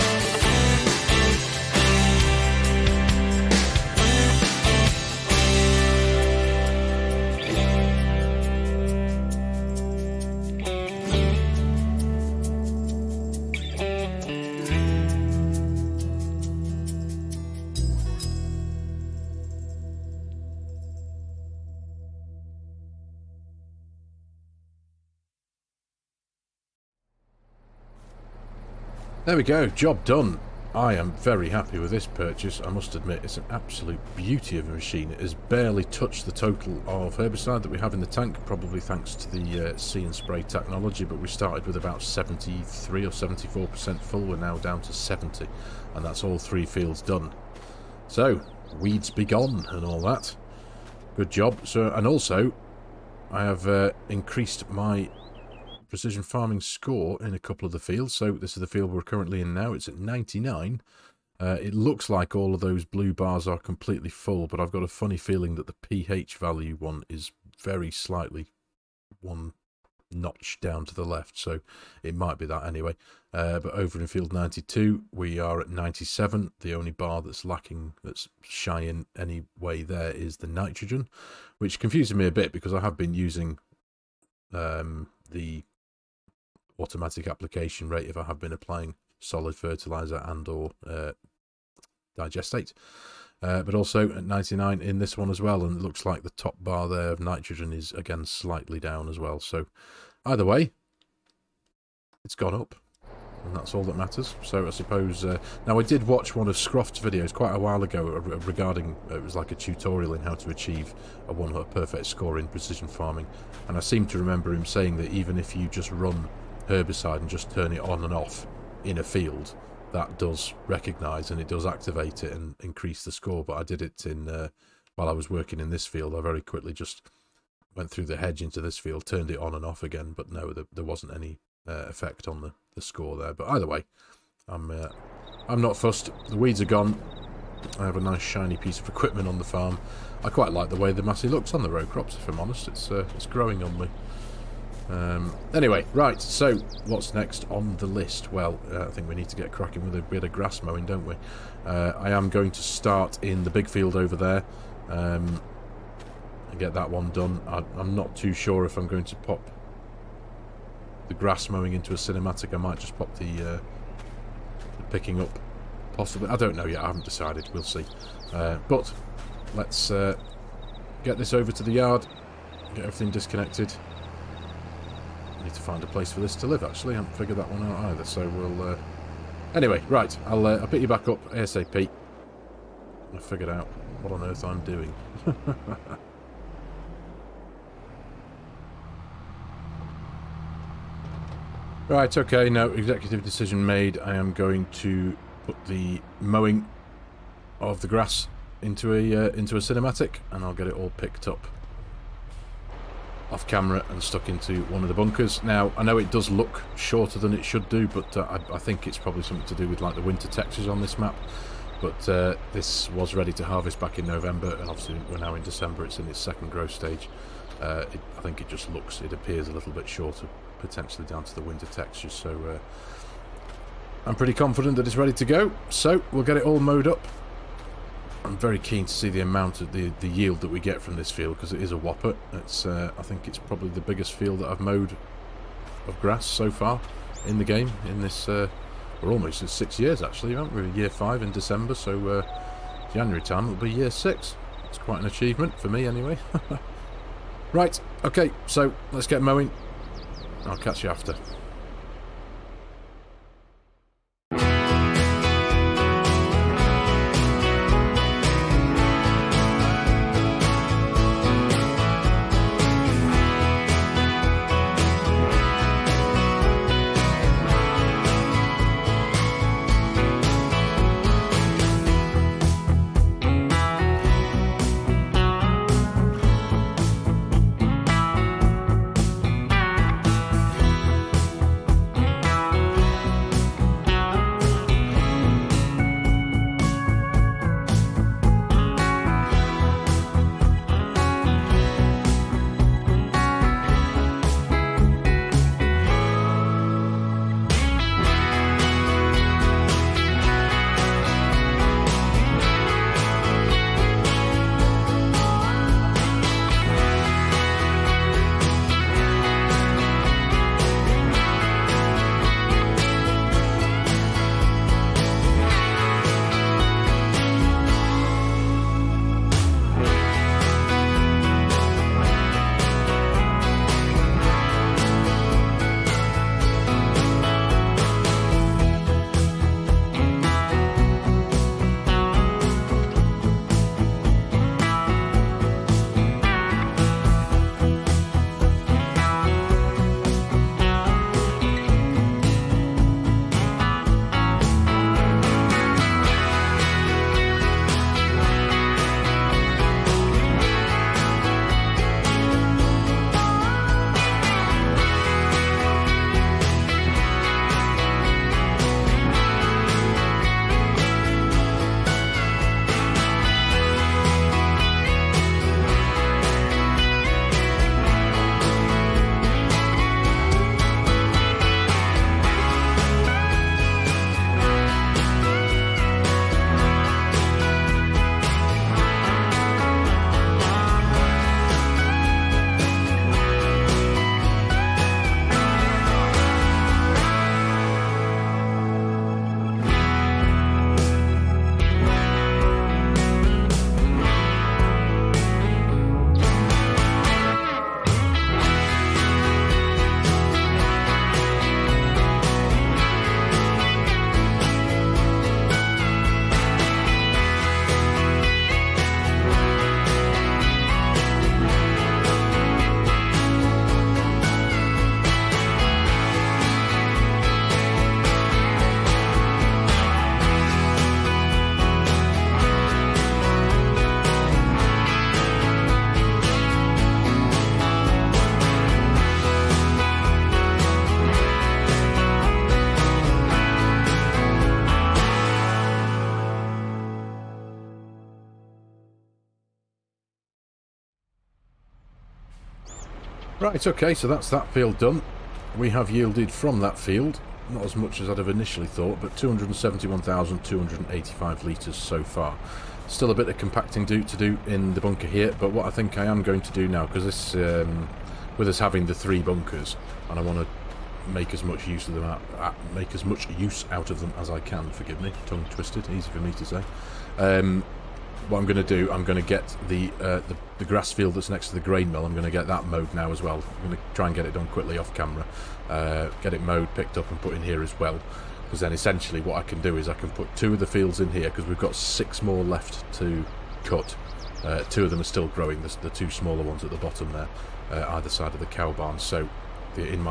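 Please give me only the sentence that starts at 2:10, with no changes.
But no, there, there wasn't any uh, effect on the, the score there.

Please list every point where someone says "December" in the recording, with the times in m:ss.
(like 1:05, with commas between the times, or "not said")
3:35, 4:01.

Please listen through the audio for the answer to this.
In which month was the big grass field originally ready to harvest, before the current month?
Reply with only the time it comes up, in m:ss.
3:34.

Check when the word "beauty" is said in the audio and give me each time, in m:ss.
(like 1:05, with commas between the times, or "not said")
0:34.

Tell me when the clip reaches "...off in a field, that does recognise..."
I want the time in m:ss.
1:58.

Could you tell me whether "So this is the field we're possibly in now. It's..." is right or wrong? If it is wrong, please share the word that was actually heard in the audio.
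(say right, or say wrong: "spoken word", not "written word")
wrong: "currently", not "possibly".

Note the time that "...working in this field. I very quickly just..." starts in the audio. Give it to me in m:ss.
2:05.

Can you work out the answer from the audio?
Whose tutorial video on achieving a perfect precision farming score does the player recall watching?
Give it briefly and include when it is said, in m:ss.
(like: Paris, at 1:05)
Scroft, at 1:46.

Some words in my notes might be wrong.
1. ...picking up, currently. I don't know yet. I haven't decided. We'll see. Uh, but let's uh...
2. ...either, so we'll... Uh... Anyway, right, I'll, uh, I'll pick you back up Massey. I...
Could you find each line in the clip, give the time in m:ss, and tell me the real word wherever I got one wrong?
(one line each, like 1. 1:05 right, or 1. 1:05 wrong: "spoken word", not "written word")
1. 2:44 wrong: "possibly", not "currently"
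2. 2:57 wrong: "ASAP", not "Massey".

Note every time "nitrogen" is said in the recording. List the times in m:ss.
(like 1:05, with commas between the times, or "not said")
1:20, 1:37.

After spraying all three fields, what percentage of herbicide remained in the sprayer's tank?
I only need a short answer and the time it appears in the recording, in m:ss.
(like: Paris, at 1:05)
70%, at 0:44.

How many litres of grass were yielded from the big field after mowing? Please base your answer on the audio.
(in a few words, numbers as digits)
271,285 litres.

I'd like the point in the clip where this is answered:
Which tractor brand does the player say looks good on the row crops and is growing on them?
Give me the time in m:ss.
2:20.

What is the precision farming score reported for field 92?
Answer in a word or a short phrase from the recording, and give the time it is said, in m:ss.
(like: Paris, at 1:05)
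97, at 1:15.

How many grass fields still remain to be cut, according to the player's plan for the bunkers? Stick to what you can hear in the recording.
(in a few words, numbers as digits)
6.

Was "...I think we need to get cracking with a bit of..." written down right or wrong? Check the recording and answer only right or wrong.
right.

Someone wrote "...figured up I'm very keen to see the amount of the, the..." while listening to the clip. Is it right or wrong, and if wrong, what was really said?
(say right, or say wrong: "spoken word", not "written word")
wrong: "mowed", not "figured".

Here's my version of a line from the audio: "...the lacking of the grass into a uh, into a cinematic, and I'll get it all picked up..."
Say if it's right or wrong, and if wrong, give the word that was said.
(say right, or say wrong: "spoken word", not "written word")
wrong: "mowing", not "lacking".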